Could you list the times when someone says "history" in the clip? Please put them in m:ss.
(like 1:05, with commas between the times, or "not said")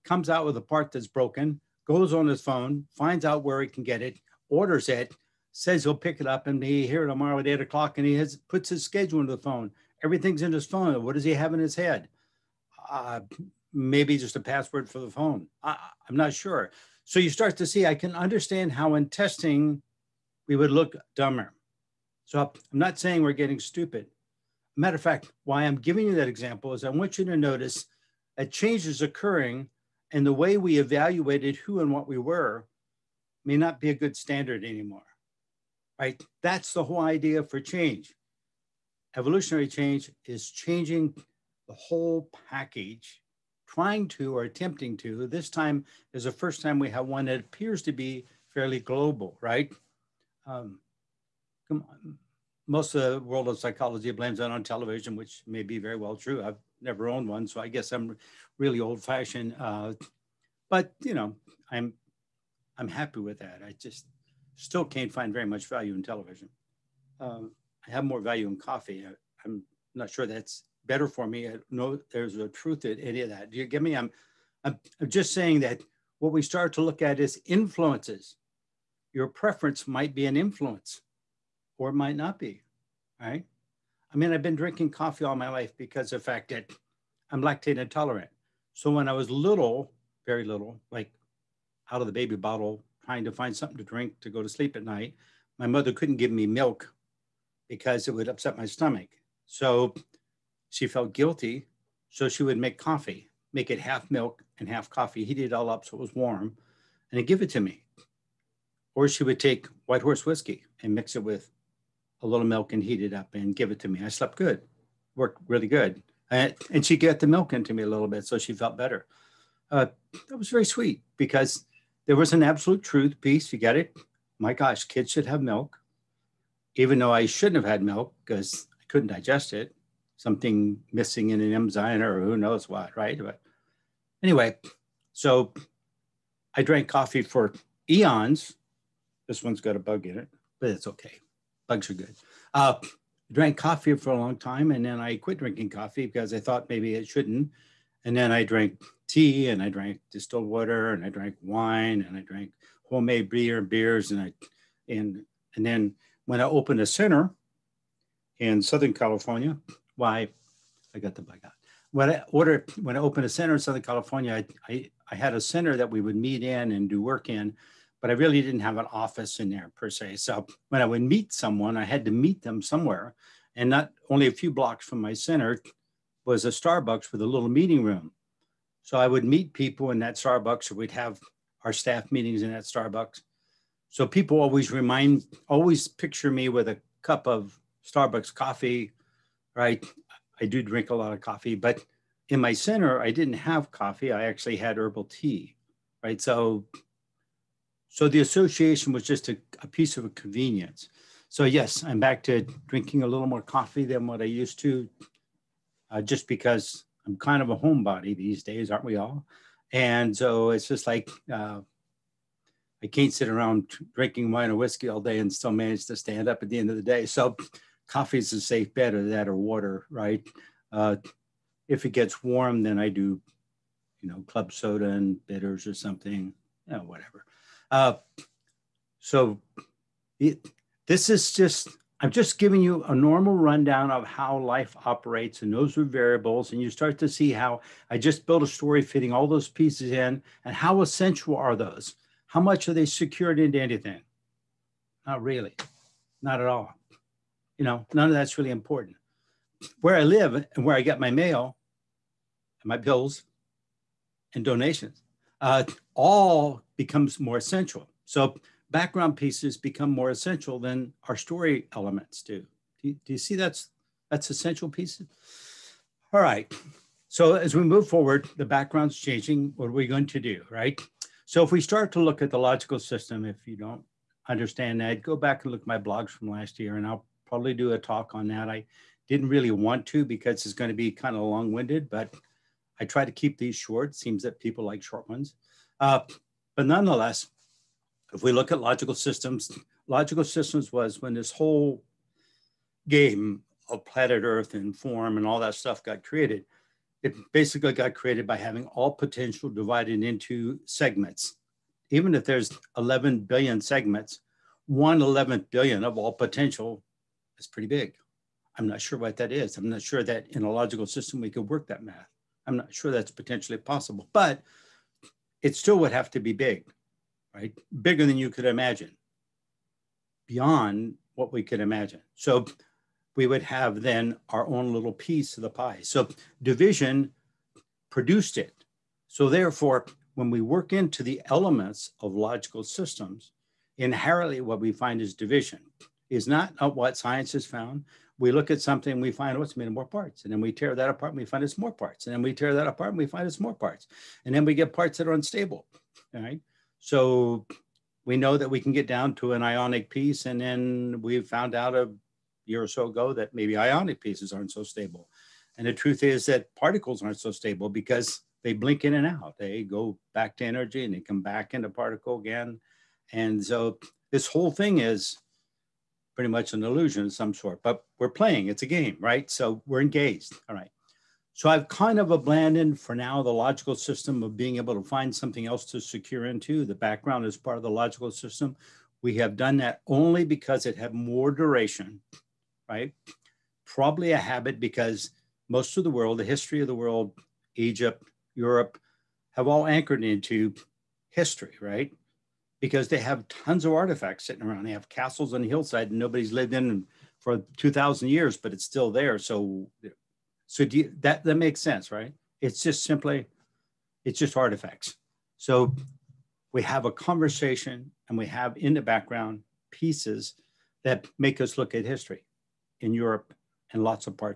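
6:26, 6:31, 6:51.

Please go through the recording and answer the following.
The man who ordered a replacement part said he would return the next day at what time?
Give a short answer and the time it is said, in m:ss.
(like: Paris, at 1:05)
8 o'clock, at 0:07.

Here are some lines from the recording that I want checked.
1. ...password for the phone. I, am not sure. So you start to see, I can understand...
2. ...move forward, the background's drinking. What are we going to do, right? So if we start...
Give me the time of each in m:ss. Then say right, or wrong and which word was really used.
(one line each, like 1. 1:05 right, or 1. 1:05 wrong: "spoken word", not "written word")
1. 0:14 right
2. 4:27 wrong: "changing", not "drinking".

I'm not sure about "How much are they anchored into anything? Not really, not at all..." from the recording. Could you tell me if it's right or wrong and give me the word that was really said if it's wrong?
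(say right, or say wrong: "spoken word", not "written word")
wrong: "secured", not "anchored".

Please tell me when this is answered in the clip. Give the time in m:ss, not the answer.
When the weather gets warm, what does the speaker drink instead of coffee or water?
3:44.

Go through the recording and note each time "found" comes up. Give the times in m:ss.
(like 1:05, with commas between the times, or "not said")
5:37, 5:51.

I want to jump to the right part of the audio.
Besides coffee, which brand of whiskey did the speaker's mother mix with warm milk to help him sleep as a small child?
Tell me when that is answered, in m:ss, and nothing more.
1:49.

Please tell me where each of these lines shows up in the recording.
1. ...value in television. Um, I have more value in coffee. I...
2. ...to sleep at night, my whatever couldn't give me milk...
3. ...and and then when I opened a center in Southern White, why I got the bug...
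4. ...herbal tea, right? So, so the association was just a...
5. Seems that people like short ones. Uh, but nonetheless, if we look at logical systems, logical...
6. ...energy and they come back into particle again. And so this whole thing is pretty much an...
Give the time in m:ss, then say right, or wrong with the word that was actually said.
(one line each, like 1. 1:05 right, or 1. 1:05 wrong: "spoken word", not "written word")
1. 1:05 right
2. 1:34 wrong: "mother", not "whatever"
3. 2:34 wrong: "California", not "White"
4. 3:14 right
5. 4:43 right
6. 6:00 right.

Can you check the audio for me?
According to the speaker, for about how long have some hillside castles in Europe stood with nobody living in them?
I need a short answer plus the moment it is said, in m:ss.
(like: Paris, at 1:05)
2000 years, at 6:37.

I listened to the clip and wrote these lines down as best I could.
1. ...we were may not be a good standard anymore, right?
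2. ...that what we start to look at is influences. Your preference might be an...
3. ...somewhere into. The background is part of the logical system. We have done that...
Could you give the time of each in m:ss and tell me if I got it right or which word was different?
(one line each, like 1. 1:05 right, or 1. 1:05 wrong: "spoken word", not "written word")
1. 0:32 right
2. 1:15 right
3. 6:15 wrong: "secure", not "somewhere".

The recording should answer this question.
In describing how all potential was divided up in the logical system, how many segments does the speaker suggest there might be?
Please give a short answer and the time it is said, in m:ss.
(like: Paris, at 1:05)
11 billion, at 5:02.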